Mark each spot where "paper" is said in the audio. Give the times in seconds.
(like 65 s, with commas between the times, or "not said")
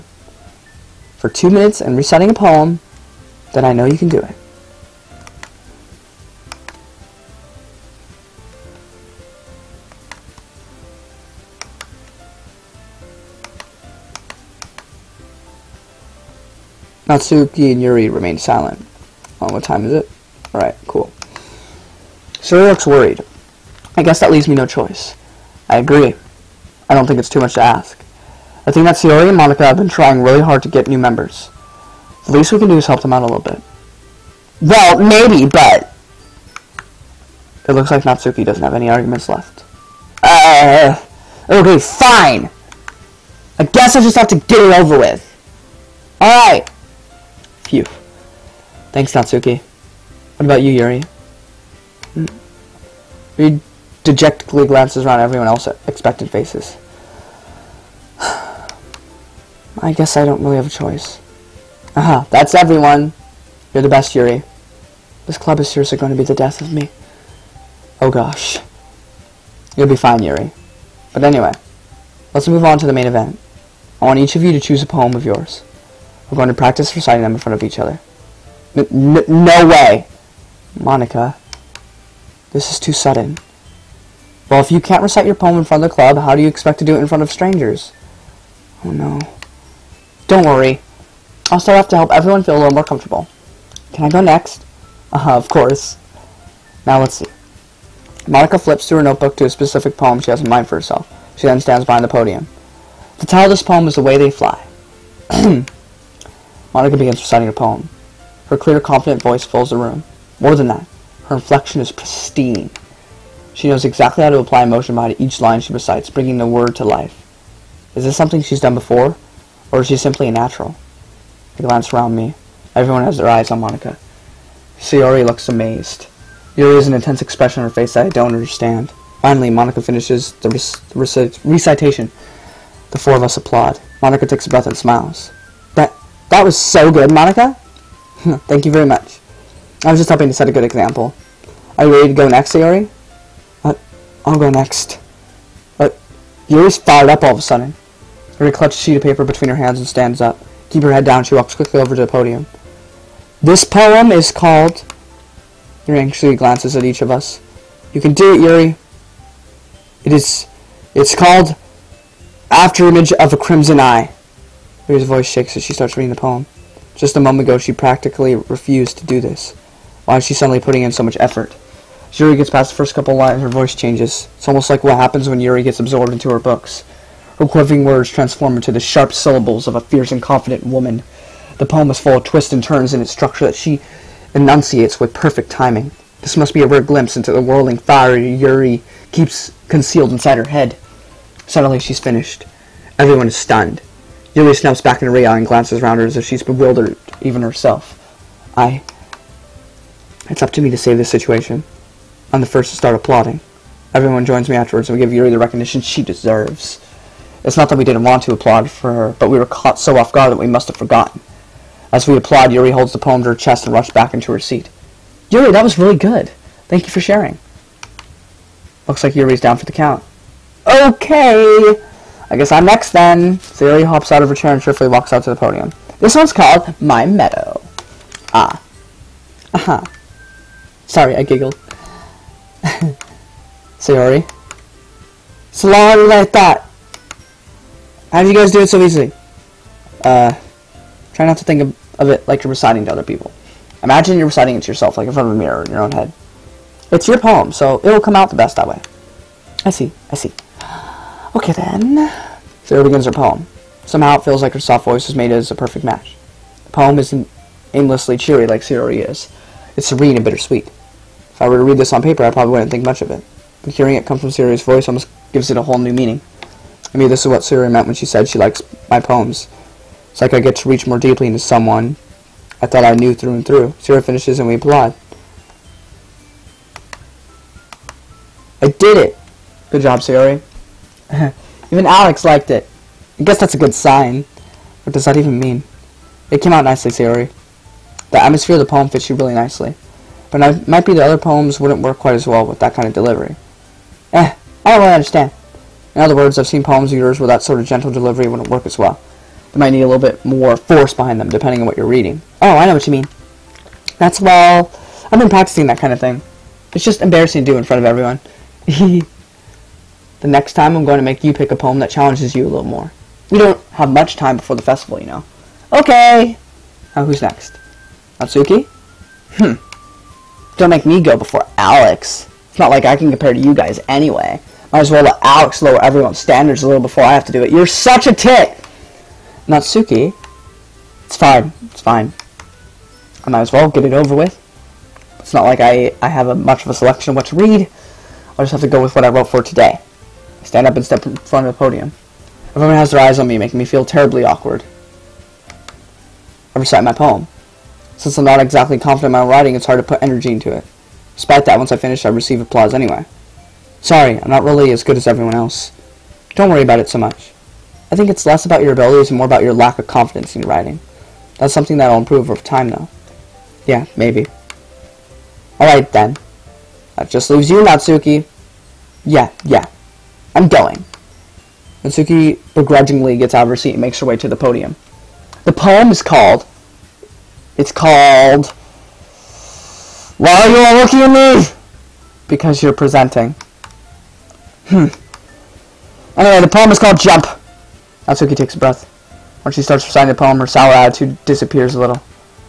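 149 s, 262 s.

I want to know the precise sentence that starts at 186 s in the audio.
This must be a rare glimpse into the whirling fire Yuri keeps concealed inside her head.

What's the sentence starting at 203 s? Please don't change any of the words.
Everyone joins me afterwards and we give Yuri the recognition she deserves.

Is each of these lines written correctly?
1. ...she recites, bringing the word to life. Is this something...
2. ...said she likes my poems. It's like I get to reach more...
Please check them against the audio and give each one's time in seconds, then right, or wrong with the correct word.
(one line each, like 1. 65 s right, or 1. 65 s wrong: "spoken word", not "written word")
1. 115 s right
2. 268 s right.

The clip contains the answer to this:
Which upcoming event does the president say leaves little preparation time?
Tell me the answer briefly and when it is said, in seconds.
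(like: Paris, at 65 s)
the festival, at 314 s.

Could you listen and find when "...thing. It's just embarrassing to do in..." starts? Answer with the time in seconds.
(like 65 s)
305 s.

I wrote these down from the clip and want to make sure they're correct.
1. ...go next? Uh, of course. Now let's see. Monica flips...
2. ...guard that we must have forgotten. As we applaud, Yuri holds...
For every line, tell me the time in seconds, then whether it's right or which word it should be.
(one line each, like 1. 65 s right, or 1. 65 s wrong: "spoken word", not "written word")
1. 94 s right
2. 210 s right.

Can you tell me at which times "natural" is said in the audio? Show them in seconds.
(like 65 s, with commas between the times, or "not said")
120 s.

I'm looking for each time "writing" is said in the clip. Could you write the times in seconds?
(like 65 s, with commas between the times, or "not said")
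349 s, 360 s.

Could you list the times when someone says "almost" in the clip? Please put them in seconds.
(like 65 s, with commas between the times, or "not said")
174 s, 264 s.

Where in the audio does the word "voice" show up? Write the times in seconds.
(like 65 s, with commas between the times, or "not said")
109 s, 165 s, 173 s, 254 s, 264 s.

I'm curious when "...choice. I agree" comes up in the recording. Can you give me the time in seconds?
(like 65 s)
24 s.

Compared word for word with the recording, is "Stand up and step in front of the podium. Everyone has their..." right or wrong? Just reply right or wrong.
right.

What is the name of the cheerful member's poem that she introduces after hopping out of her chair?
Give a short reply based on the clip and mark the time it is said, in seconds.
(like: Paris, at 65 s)
My Meadow, at 226 s.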